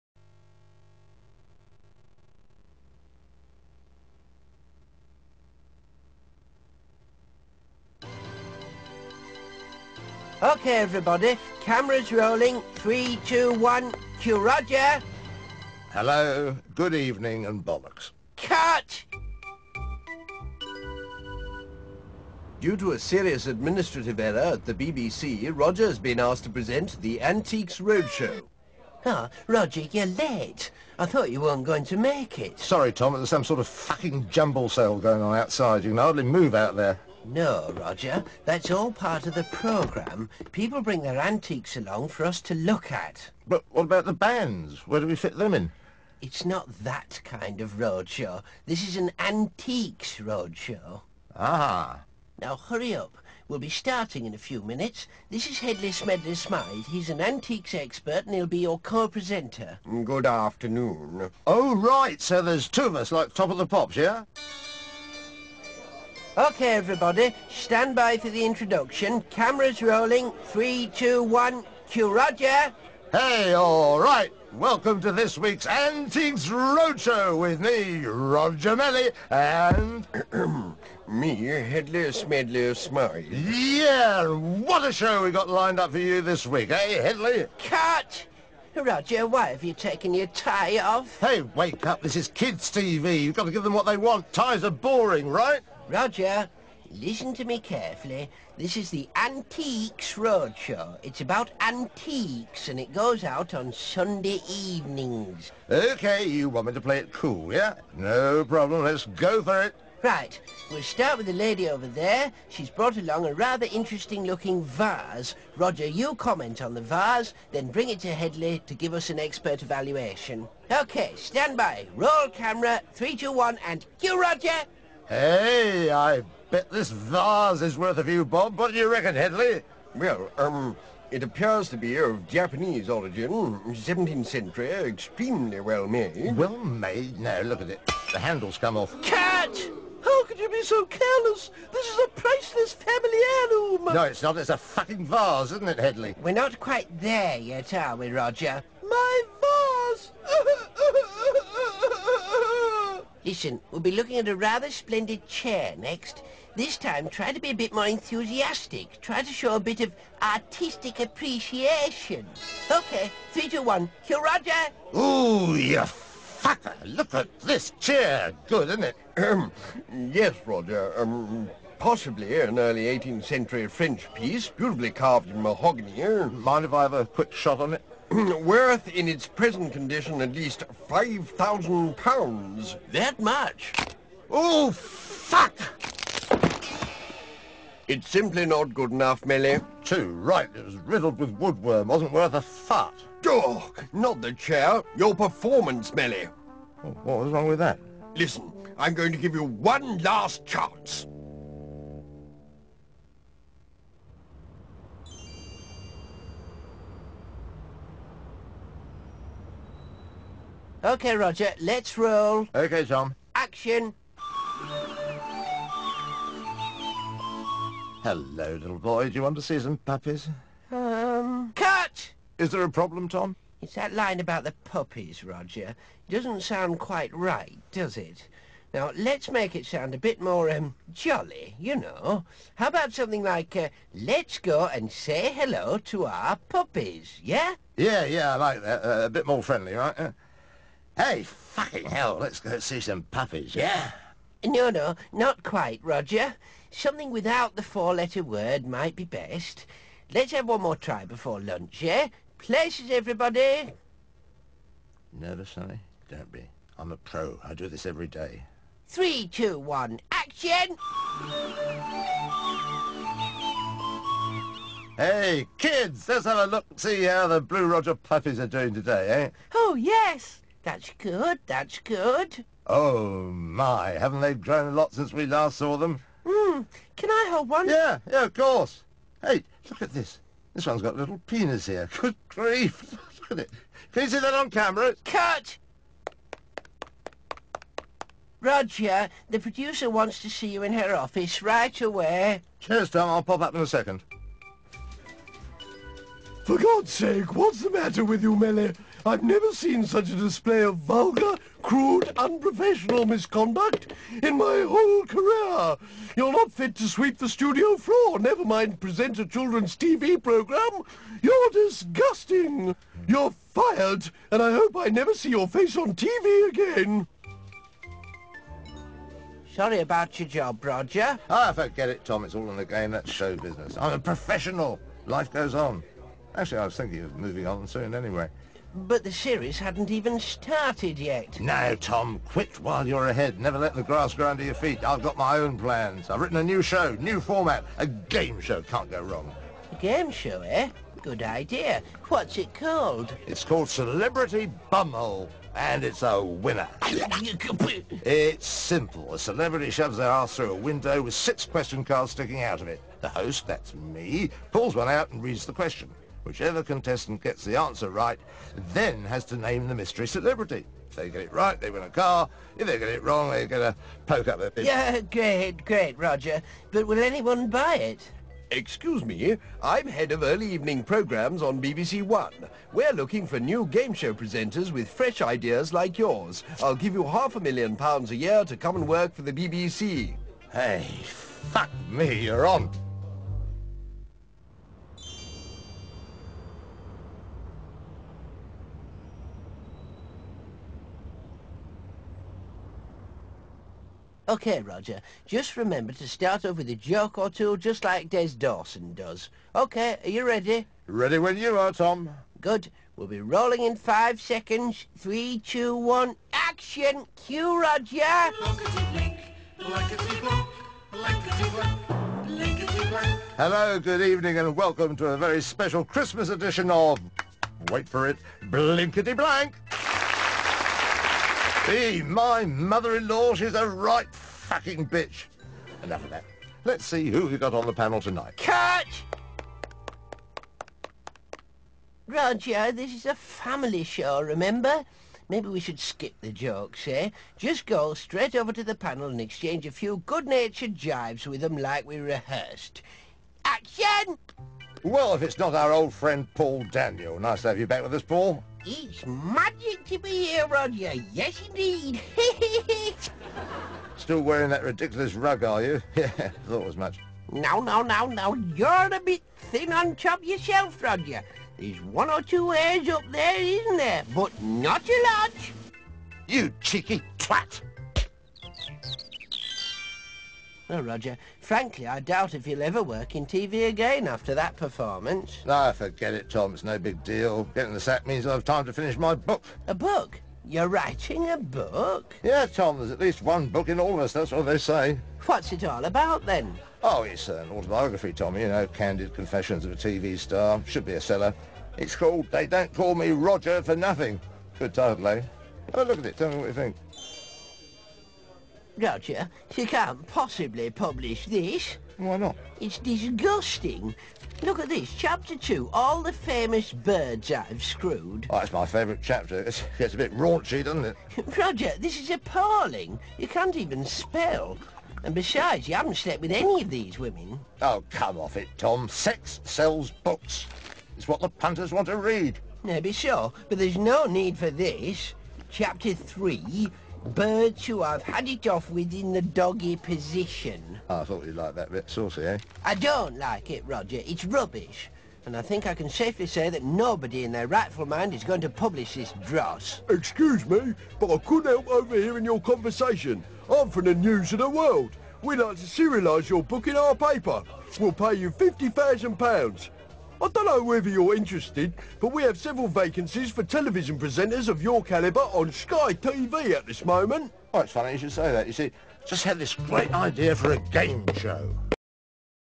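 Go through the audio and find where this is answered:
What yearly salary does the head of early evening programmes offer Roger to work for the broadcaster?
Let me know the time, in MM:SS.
06:17.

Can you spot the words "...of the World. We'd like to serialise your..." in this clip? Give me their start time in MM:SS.
09:04.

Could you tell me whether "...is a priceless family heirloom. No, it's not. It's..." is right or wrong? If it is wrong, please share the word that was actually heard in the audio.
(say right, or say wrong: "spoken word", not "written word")
right.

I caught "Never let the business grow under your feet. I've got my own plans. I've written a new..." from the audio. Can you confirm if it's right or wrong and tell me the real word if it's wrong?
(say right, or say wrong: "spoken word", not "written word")
wrong: "grass", not "business".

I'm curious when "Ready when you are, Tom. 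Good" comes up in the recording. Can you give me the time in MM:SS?
06:40.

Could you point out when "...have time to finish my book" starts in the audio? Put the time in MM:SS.
07:58.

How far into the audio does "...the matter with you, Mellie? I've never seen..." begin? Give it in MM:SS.
04:57.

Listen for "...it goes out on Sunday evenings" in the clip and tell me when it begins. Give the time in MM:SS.
01:42.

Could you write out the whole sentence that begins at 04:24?
Hey, kids, let's have a look see how the Blue Roger puppies are doing today, eh?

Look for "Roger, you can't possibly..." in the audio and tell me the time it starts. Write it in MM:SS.
08:18.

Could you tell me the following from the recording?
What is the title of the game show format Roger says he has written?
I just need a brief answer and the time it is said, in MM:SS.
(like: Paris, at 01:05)
Celebrity Bumhole, at 05:43.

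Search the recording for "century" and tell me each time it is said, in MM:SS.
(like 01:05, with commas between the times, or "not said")
02:14, 02:53.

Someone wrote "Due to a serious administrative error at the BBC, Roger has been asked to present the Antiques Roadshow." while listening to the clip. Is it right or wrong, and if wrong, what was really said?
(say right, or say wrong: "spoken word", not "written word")
right.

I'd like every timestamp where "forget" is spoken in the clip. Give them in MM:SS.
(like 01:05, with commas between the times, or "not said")
05:21, 07:55.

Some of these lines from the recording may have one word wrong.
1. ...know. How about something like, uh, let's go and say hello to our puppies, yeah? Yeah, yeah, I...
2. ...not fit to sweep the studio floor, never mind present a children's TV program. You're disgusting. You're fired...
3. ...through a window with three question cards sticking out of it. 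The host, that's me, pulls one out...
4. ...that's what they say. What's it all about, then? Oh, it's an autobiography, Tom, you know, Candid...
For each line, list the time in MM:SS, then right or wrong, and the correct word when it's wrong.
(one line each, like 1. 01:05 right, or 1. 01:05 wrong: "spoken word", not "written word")
1. 03:51 right
2. 05:06 right
3. 05:50 wrong: "six", not "three"
4. 08:04 right.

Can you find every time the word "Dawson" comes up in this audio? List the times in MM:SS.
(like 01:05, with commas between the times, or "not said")
06:38.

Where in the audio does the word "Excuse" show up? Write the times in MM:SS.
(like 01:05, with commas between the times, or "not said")
06:08, 08:59.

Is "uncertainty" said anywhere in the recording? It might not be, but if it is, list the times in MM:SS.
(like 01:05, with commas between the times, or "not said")
not said.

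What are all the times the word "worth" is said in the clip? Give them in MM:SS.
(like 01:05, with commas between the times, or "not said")
02:07, 02:58, 03:12.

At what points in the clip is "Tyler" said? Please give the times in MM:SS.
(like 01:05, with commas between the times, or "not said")
not said.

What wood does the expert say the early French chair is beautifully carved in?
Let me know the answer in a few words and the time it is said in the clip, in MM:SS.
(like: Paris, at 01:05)
Mahogany, at 02:55.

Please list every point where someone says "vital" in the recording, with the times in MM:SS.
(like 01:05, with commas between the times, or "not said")
not said.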